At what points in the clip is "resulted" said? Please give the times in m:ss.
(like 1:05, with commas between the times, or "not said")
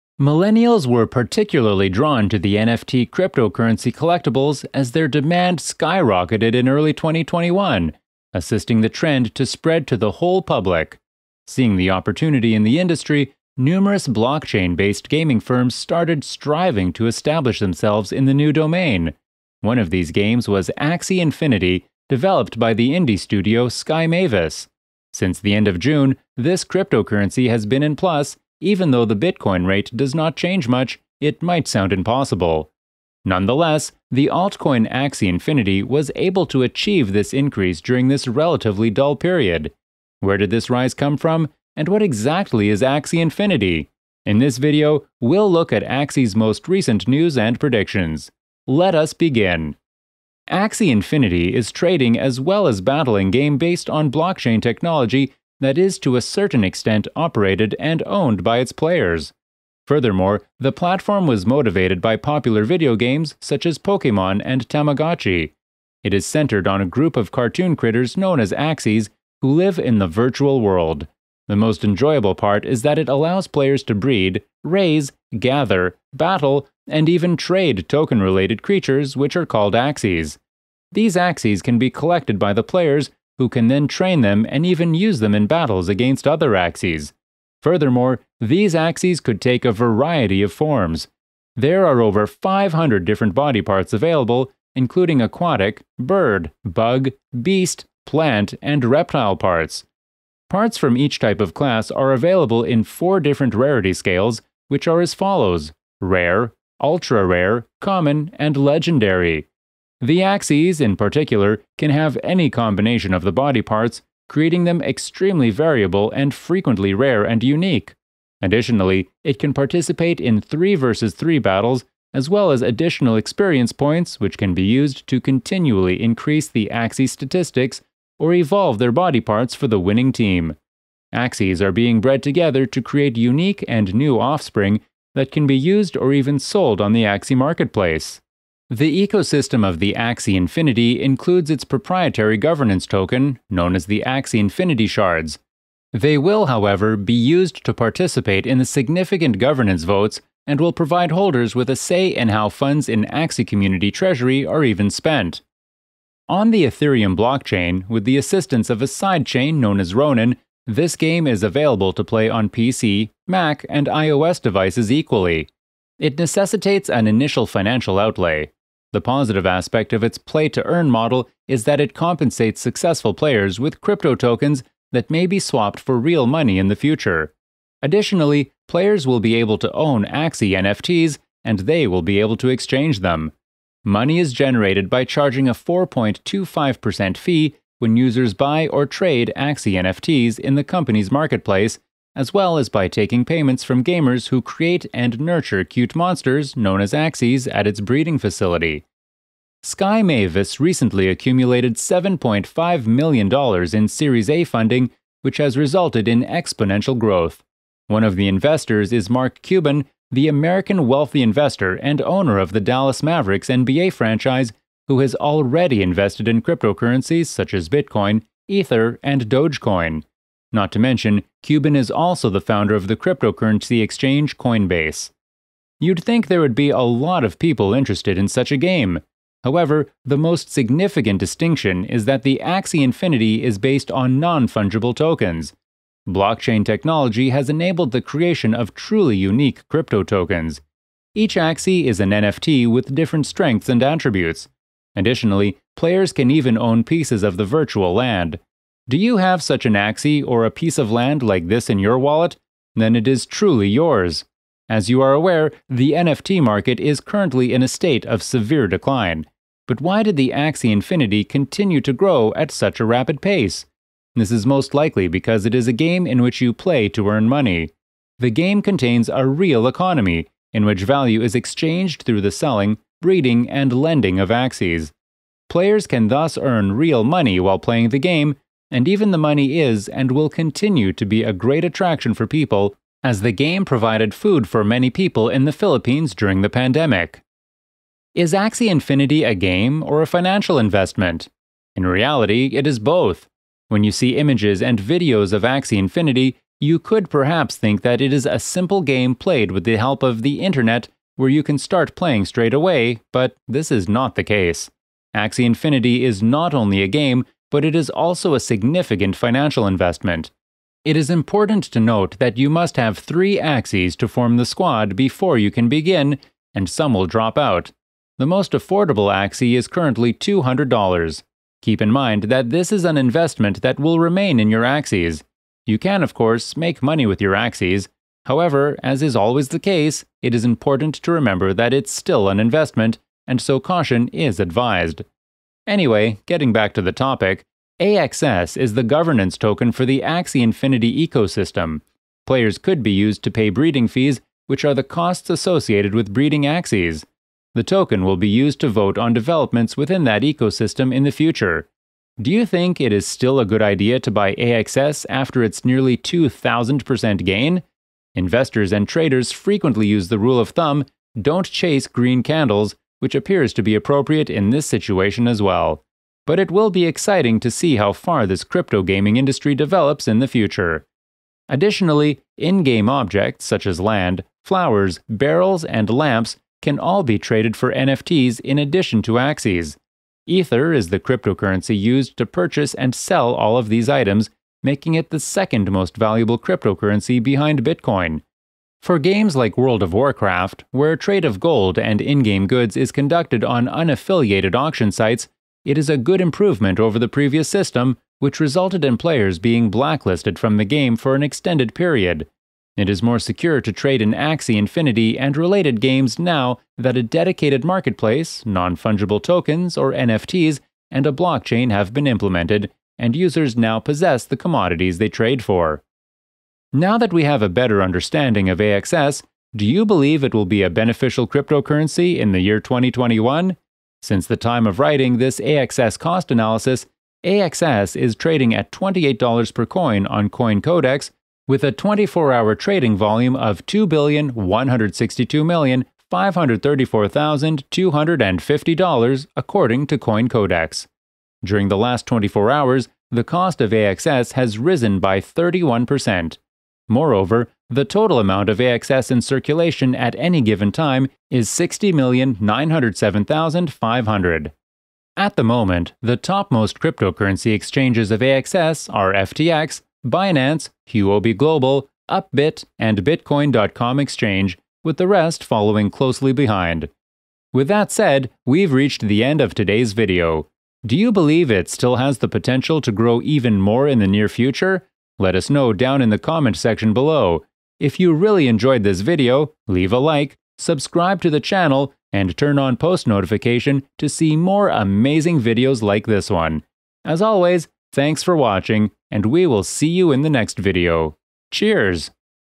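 3:25, 6:38.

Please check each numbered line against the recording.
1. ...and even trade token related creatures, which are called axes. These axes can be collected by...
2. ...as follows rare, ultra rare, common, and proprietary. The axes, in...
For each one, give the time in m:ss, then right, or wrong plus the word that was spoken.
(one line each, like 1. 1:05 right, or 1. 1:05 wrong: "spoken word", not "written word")
1. 1:16 right
2. 1:45 wrong: "legendary", not "proprietary".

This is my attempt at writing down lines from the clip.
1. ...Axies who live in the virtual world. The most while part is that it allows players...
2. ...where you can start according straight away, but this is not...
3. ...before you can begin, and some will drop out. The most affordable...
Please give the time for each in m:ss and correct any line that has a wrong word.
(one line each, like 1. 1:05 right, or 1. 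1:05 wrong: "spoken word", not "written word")
1. 1:08 wrong: "enjoyable", not "while"
2. 5:01 wrong: "playing", not "according"
3. 5:14 right.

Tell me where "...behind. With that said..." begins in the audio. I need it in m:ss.
7:46.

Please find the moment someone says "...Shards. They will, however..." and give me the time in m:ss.
2:24.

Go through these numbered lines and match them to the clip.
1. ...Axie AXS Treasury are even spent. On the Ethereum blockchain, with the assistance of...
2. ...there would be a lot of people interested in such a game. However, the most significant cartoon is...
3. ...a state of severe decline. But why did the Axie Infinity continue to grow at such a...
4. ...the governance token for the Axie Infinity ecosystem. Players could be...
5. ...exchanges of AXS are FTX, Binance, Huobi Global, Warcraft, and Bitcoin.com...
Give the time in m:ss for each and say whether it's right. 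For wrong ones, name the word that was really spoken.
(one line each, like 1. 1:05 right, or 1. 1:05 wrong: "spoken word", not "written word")
1. 2:33 wrong: "Community", not "AXS"
2. 3:46 wrong: "distinction", not "cartoon"
3. 4:17 right
4. 5:38 right
5. 7:37 wrong: "Upbit", not "Warcraft".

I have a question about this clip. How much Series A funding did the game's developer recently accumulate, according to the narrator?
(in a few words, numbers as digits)
$7.5 million.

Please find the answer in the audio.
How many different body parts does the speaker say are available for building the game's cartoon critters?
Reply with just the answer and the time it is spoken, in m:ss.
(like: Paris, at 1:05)
over 500, at 1:32.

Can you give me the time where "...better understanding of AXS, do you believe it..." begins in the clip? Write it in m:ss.
6:57.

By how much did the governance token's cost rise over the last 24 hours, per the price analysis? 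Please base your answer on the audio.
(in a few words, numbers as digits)
31%.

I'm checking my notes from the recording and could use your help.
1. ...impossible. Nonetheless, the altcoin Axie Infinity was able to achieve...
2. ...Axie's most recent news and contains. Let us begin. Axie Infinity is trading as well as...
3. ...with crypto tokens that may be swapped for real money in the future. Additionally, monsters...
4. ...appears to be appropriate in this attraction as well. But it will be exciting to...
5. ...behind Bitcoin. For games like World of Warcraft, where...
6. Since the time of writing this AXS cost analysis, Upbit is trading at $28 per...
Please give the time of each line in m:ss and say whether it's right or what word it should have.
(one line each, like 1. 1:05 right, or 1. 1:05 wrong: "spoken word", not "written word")
1. 0:31 right
2. 0:45 wrong: "predictions", not "contains"
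3. 2:53 wrong: "players", not "monsters"
4. 6:03 wrong: "situation", not "attraction"
5. 6:27 right
6. 7:04 wrong: "AXS", not "Upbit".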